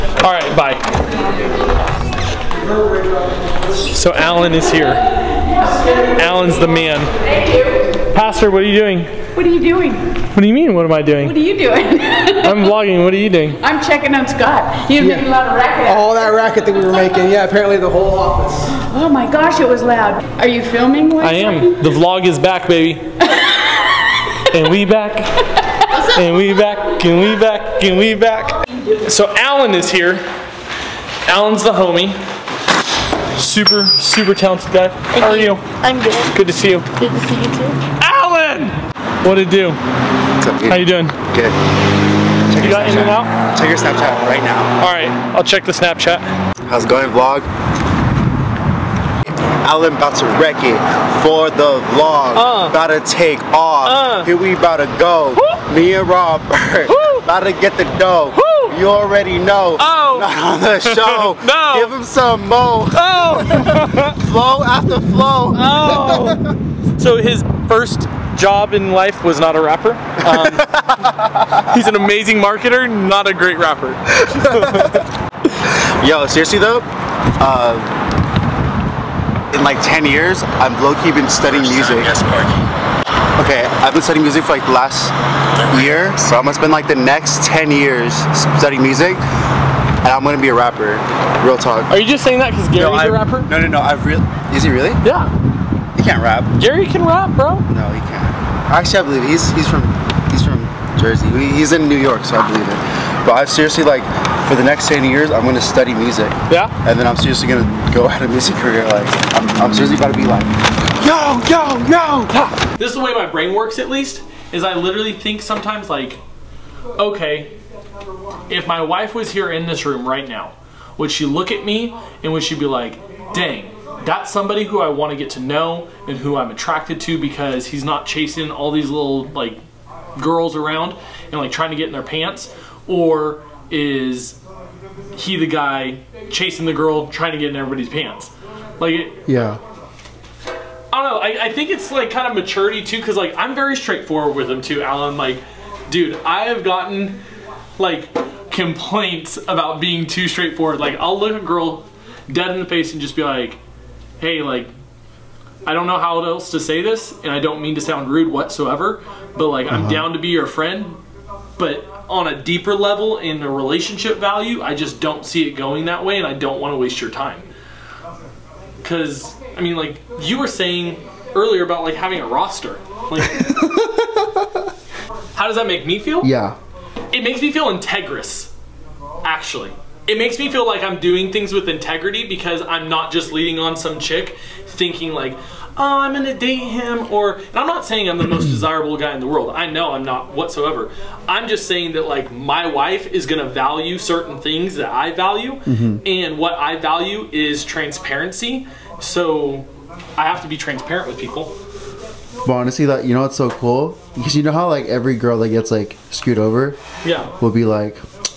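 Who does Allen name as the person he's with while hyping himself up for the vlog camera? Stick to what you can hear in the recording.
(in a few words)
Robert.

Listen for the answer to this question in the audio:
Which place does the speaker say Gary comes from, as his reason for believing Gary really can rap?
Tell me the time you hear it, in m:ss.
1:40.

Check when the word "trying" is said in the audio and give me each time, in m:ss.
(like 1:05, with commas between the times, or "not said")
2:11, 2:17.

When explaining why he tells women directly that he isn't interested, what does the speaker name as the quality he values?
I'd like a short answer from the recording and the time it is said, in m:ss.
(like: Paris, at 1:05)
Transparency, at 3:17.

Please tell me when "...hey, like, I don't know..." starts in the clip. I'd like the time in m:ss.
2:34.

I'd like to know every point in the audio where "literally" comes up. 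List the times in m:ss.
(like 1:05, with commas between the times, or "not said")
1:54.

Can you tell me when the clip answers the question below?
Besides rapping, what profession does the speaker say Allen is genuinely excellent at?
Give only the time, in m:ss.
1:12.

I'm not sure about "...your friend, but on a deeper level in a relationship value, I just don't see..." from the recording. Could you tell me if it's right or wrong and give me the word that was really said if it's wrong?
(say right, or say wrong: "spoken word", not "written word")
right.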